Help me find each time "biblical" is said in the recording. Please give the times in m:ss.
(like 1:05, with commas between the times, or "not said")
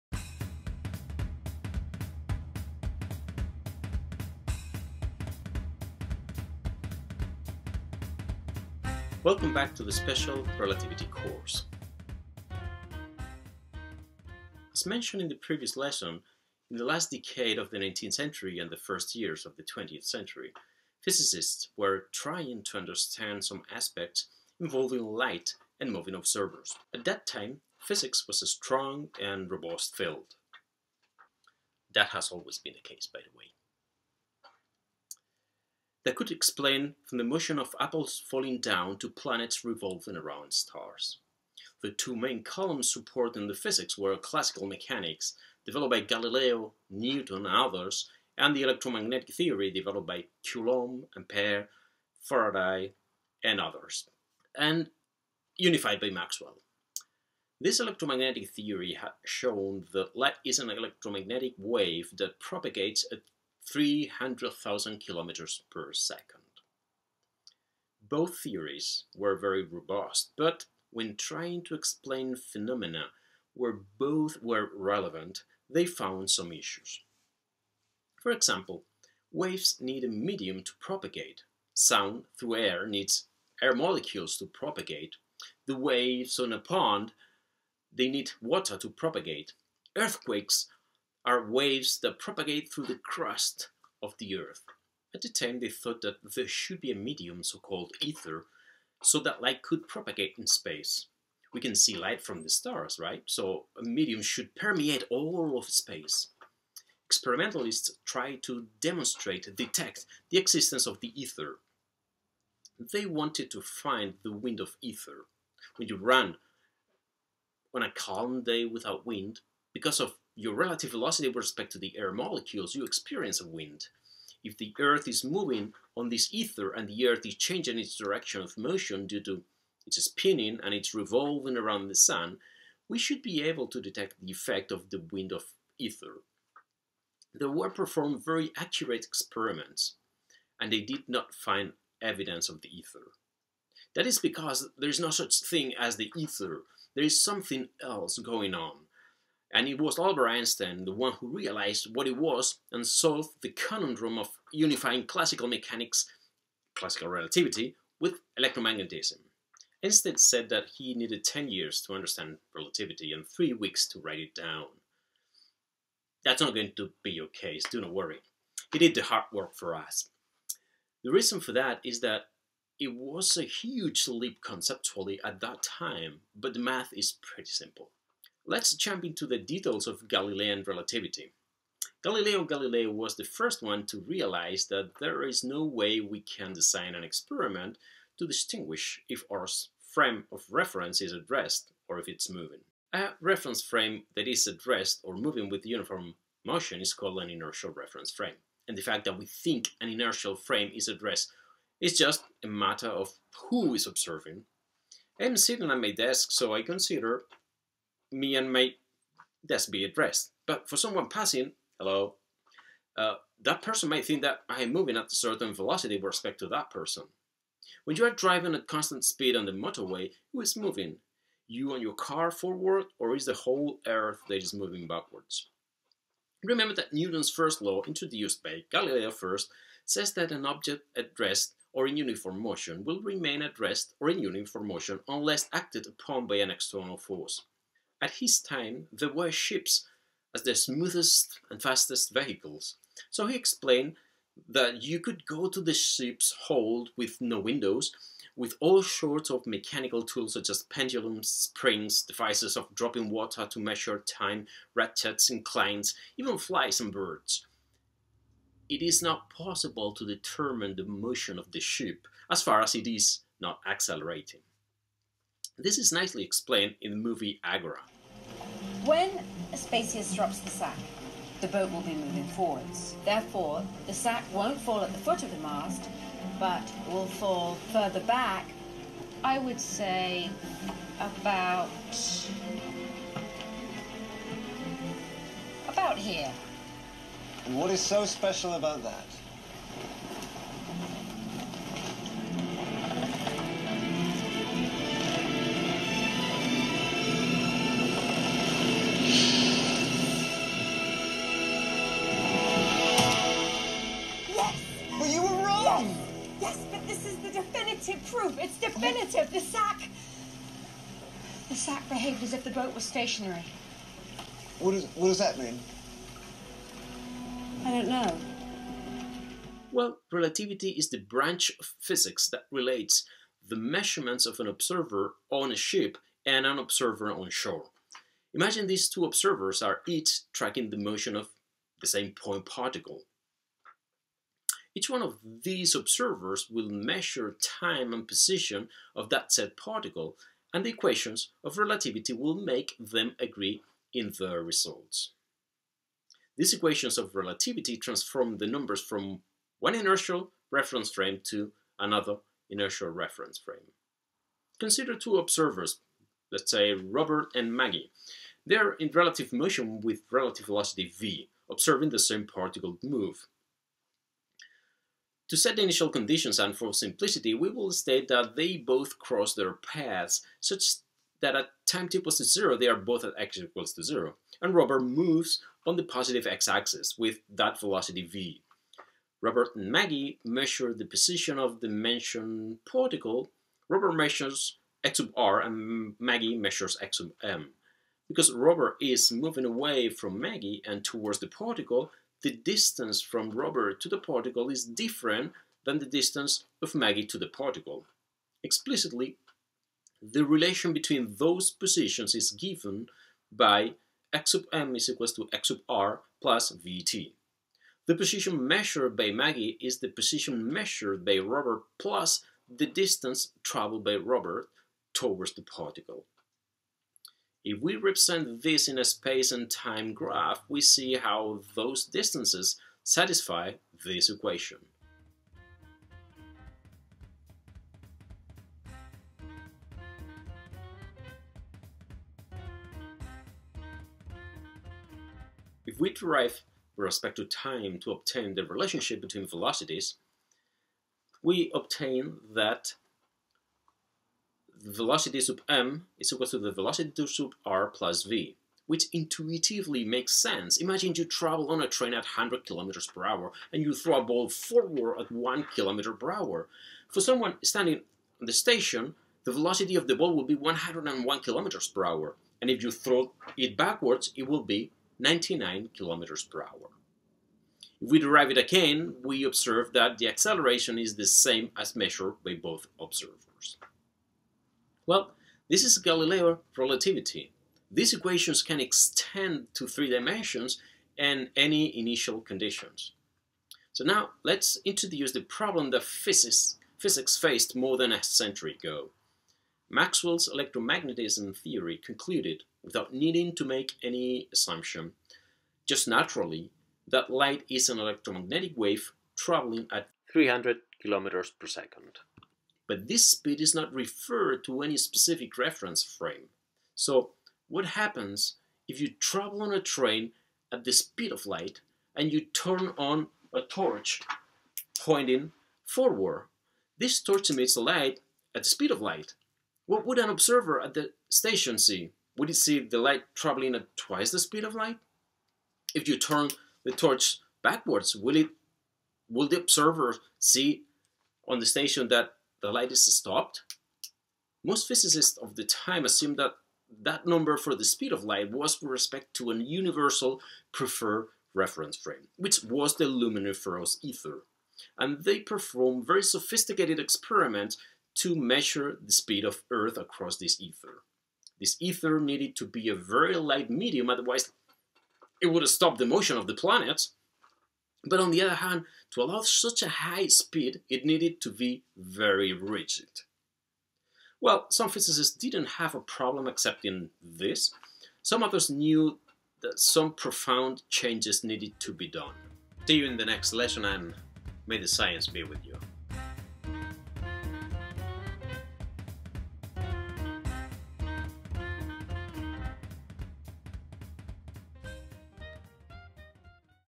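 not said.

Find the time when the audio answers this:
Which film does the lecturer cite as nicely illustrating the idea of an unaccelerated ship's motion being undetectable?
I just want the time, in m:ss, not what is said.
4:27.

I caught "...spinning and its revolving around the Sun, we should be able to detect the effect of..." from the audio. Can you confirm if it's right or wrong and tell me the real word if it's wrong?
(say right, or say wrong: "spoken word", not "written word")
right.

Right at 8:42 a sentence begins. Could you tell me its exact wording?
Would he see the light traveling at twice the speed of light?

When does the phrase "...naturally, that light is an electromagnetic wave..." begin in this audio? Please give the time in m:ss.
8:15.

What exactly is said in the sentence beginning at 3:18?
And the fact that we think an inertial frame is at rest is just a matter of who is observing.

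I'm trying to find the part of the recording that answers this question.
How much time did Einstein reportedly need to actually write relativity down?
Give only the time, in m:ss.
2:43.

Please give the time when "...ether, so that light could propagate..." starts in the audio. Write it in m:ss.
1:38.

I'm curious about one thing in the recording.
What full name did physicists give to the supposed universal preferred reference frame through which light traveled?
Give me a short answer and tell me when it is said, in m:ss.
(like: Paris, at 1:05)
luminiferous ether, at 9:02.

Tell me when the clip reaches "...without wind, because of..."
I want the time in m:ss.
1:58.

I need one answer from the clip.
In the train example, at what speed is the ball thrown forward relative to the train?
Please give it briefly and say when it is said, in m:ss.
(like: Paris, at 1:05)
1 km/h, at 7:35.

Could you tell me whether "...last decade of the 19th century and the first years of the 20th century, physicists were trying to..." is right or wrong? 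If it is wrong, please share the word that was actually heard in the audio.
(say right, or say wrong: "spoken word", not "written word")
right.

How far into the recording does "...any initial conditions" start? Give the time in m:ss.
8:01.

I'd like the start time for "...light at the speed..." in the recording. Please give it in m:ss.
8:37.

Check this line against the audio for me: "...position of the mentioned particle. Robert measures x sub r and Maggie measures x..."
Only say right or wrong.
right.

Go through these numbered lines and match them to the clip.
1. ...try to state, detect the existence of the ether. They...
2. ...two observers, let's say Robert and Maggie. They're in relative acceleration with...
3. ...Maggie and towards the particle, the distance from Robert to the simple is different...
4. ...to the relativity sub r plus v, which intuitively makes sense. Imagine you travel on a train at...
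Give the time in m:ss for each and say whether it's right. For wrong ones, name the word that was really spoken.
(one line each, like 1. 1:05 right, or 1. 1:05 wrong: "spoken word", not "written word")
1. 1:48 wrong: "demonstrate", not "state"
2. 5:54 wrong: "motion", not "acceleration"
3. 6:30 wrong: "particle", not "simple"
4. 7:26 wrong: "velocity", not "relativity".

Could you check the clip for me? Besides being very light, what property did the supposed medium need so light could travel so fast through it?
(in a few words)
very rigid.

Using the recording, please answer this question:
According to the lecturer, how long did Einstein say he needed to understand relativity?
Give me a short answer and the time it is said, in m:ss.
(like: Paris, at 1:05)
10 years, at 2:41.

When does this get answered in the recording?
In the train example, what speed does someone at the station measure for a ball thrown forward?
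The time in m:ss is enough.
7:40.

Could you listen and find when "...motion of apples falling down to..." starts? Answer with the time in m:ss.
0:37.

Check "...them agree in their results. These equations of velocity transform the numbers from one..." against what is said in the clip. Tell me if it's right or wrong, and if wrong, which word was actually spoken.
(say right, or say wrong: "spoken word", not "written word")
wrong: "relativity", not "velocity".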